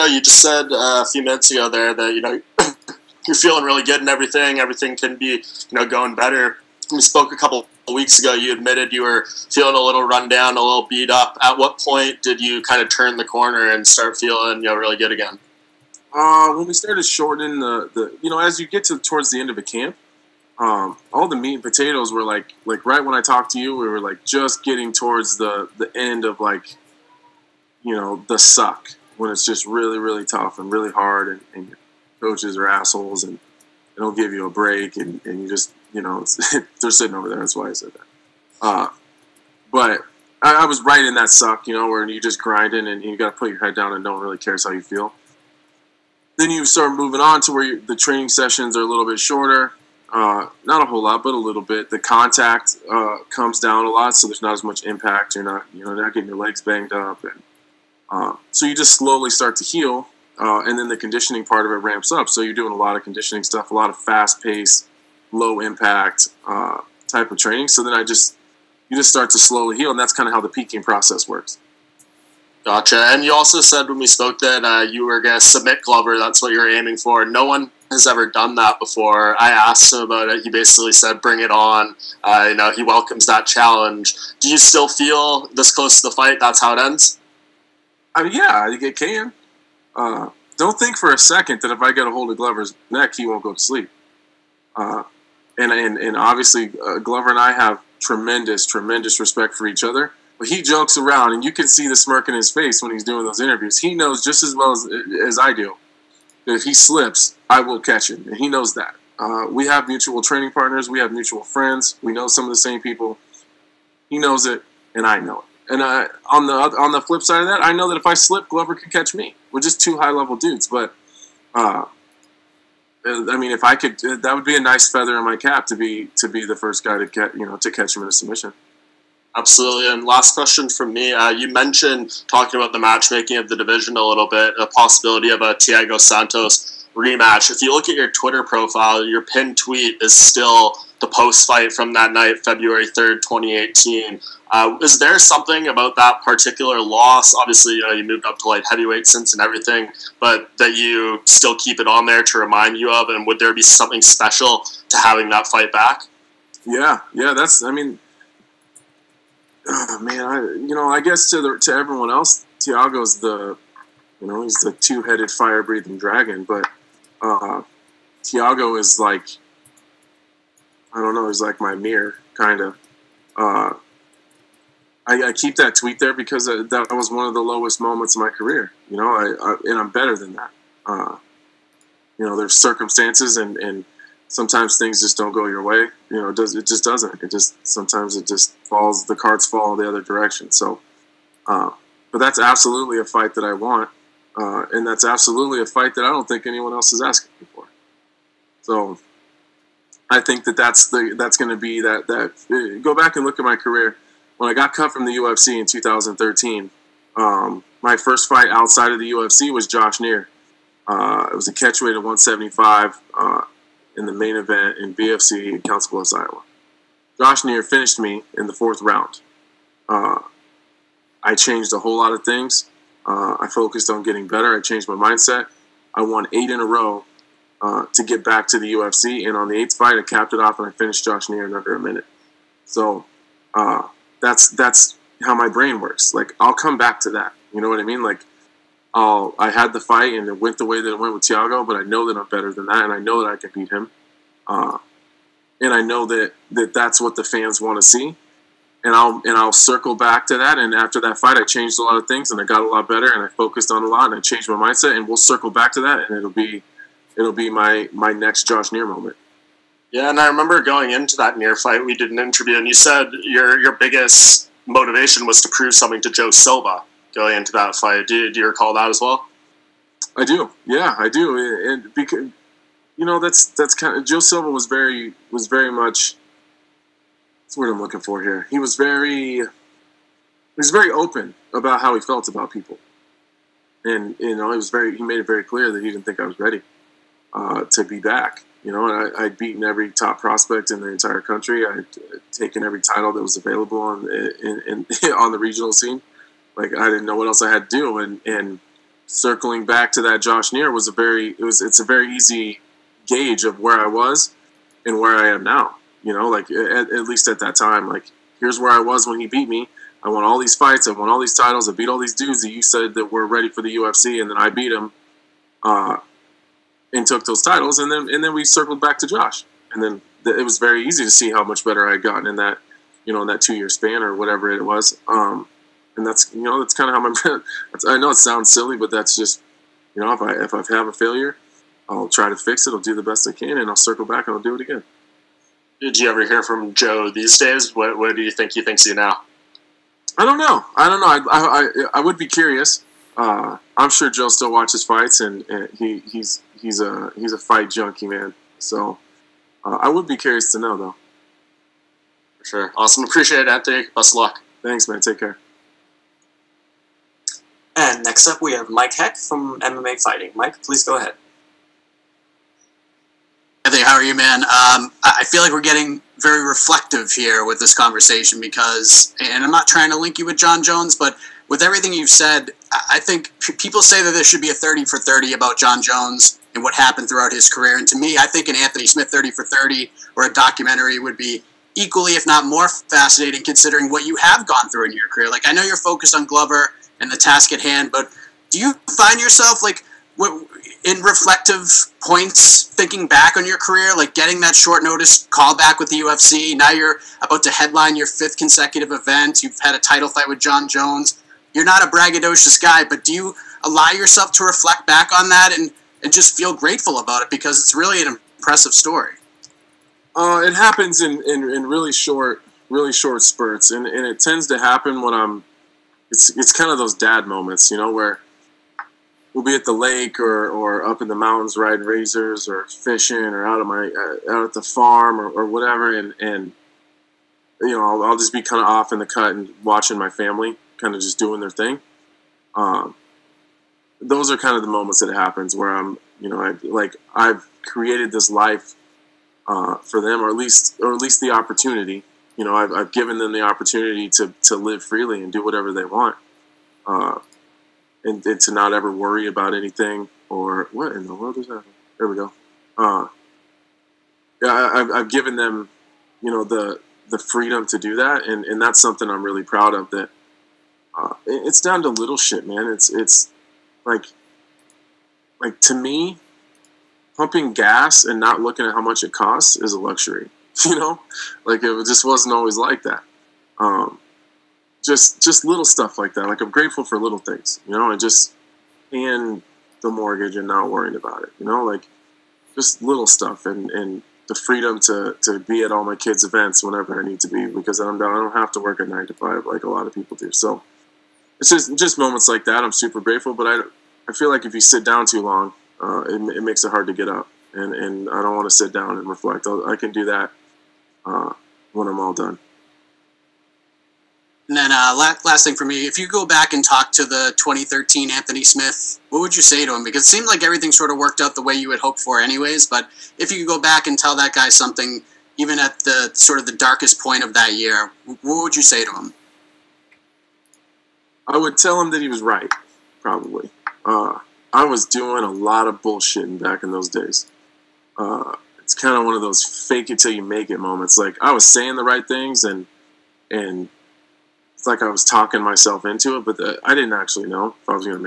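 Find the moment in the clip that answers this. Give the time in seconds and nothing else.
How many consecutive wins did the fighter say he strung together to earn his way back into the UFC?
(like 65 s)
226 s.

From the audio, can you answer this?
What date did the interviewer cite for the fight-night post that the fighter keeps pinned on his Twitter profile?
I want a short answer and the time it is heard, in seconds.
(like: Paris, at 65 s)
February 3rd, 2018, at 142 s.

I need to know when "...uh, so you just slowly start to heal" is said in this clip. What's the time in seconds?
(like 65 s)
58 s.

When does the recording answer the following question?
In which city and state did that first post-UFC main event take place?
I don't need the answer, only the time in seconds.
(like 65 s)
215 s.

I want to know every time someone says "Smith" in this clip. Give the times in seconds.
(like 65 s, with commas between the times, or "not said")
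378 s, 508 s.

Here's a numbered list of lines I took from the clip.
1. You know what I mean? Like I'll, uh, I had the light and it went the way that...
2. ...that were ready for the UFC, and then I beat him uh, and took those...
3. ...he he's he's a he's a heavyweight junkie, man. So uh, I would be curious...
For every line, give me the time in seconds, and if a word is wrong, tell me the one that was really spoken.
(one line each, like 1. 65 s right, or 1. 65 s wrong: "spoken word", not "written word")
1. 237 s wrong: "fight", not "light"
2. 312 s right
3. 345 s wrong: "fight", not "heavyweight".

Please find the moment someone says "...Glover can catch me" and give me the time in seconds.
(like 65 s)
118 s.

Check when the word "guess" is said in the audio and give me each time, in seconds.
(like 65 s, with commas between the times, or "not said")
161 s.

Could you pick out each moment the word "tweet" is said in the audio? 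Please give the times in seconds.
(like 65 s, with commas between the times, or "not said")
139 s, 175 s.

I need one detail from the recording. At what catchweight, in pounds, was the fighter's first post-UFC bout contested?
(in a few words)
175.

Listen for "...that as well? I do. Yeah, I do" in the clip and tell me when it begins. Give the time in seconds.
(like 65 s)
268 s.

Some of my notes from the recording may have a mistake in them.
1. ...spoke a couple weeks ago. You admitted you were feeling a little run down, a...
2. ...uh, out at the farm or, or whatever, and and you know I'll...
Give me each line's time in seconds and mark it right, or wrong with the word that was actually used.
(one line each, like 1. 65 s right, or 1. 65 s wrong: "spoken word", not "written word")
1. 7 s right
2. 423 s right.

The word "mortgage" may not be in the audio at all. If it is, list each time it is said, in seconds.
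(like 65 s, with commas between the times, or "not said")
479 s.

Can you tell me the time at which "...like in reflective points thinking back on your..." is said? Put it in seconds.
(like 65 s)
389 s.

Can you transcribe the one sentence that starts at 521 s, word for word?
I would tell him that he was right, probably.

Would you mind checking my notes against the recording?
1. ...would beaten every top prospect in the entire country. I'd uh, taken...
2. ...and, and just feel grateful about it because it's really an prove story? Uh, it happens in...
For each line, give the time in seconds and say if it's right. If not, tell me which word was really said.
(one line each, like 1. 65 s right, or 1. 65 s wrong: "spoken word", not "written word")
1. 289 s right
2. 405 s wrong: "impressive", not "prove".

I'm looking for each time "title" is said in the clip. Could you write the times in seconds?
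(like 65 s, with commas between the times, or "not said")
292 s, 311 s, 317 s, 399 s.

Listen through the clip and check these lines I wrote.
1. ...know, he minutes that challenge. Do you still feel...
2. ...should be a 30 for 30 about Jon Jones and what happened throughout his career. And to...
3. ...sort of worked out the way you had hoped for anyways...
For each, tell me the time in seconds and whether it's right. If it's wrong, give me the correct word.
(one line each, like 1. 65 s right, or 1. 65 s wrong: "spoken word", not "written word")
1. 82 s wrong: "welcomes", not "minutes"
2. 374 s right
3. 510 s right.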